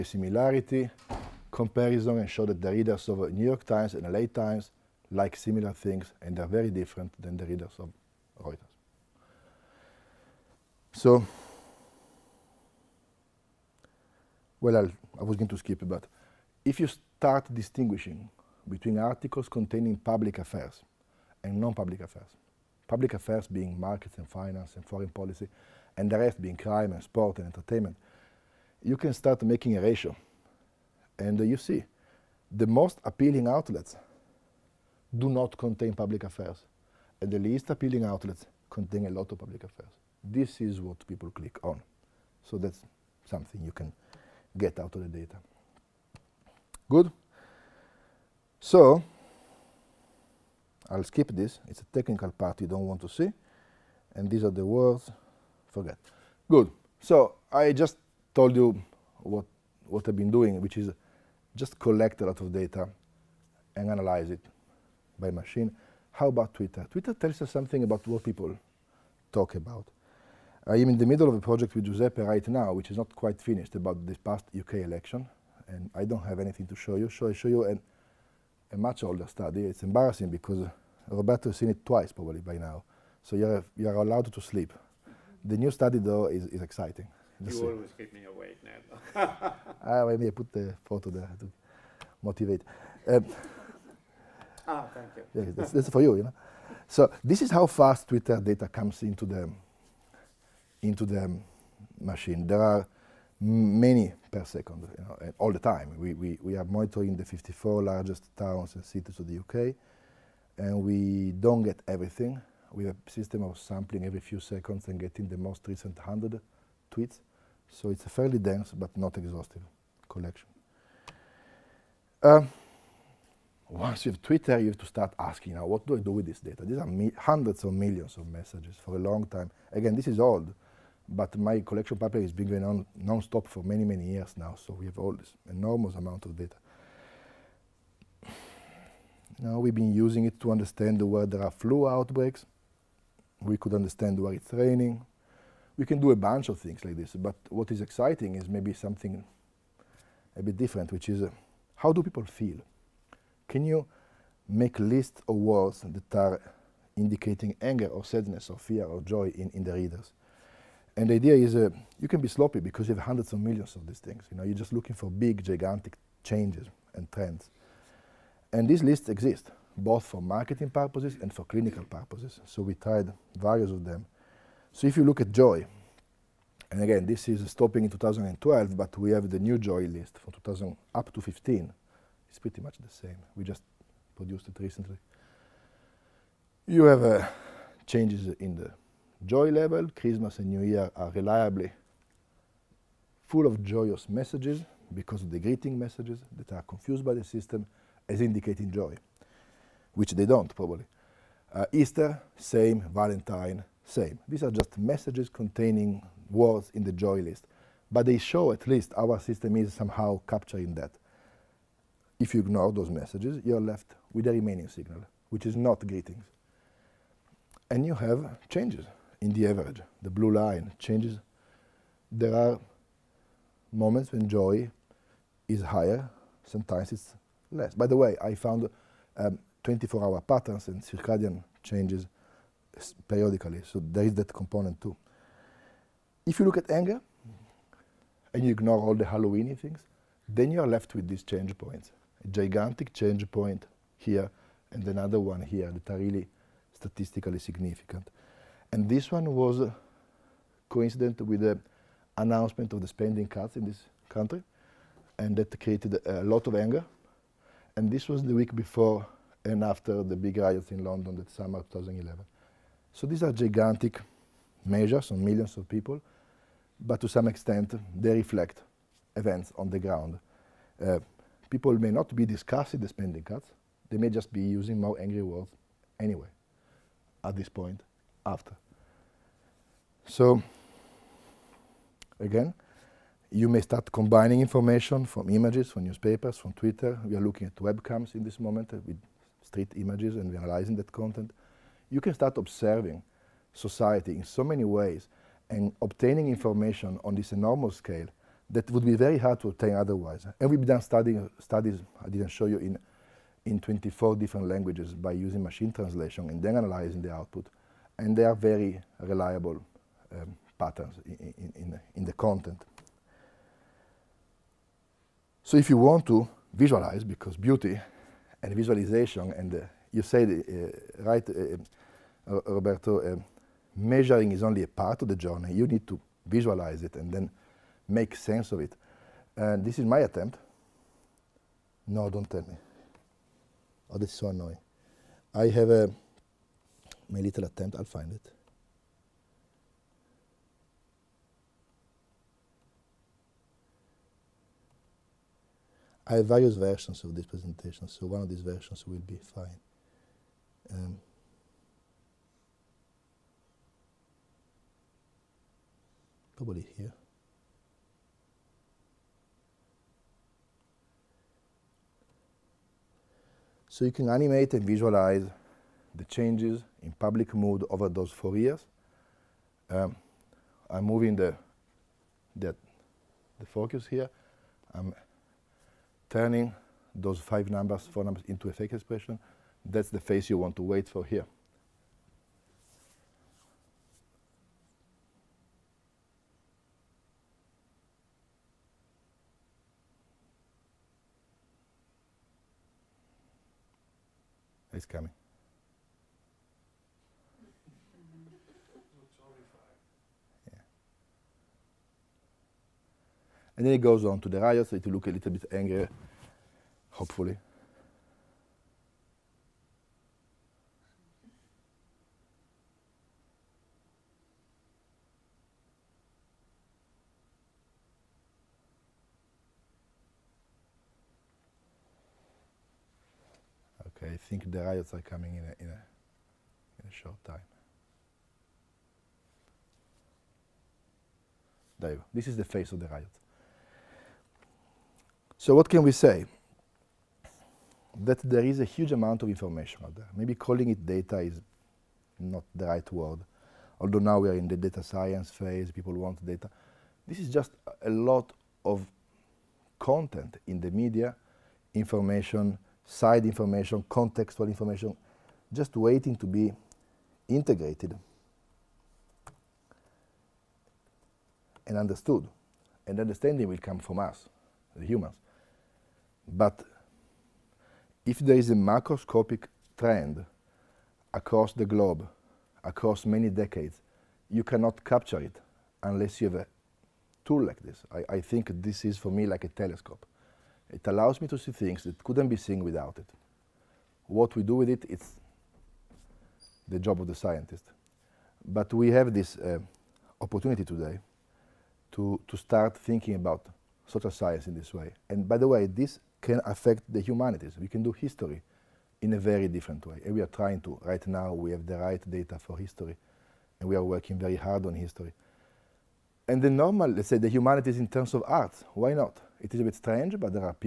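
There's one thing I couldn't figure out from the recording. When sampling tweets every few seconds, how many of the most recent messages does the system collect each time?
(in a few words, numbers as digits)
100.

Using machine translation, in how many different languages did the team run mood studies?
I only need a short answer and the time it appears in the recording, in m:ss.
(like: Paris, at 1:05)
24, at 5:03.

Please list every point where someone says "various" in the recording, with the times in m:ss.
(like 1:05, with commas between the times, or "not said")
2:53, 5:46.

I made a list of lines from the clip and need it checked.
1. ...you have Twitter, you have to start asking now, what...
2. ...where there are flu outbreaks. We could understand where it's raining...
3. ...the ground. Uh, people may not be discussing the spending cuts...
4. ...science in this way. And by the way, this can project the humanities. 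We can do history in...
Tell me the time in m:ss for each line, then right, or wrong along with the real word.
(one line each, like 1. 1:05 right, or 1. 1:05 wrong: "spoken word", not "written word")
1. 2:04 right
2. 2:21 right
3. 4:29 right
4. 8:14 wrong: "affect", not "project".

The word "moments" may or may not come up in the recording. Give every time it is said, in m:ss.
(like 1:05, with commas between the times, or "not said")
3:43, 4:48.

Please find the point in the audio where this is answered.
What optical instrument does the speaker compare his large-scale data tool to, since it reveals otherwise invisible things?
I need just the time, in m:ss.
7:59.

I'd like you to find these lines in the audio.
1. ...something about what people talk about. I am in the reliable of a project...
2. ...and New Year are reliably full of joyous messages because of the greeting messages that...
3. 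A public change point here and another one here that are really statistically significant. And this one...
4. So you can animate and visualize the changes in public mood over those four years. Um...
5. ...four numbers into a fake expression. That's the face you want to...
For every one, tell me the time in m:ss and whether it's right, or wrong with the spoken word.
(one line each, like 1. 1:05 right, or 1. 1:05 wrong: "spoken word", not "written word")
1. 1:07 wrong: "middle", not "reliable"
2. 3:10 right
3. 4:02 wrong: "gigantic", not "public"
4. 6:03 right
5. 6:17 right.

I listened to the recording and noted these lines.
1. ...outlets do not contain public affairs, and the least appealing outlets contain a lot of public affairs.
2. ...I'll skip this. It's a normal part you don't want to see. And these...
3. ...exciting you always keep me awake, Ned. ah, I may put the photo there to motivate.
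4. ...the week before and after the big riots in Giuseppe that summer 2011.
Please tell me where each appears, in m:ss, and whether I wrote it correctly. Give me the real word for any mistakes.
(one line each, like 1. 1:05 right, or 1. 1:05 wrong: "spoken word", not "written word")
1. 0:33 right
2. 0:50 wrong: "technical", not "normal"
3. 1:26 right
4. 4:18 wrong: "London", not "Giuseppe".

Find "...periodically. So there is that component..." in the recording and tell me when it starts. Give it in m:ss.
3:53.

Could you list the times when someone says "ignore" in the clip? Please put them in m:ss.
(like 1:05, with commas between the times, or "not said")
3:32, 3:58.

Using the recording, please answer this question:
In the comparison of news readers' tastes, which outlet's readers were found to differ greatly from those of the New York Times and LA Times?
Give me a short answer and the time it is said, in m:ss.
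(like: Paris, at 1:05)
Reuters, at 0:08.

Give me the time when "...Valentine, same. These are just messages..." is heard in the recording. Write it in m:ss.
3:22.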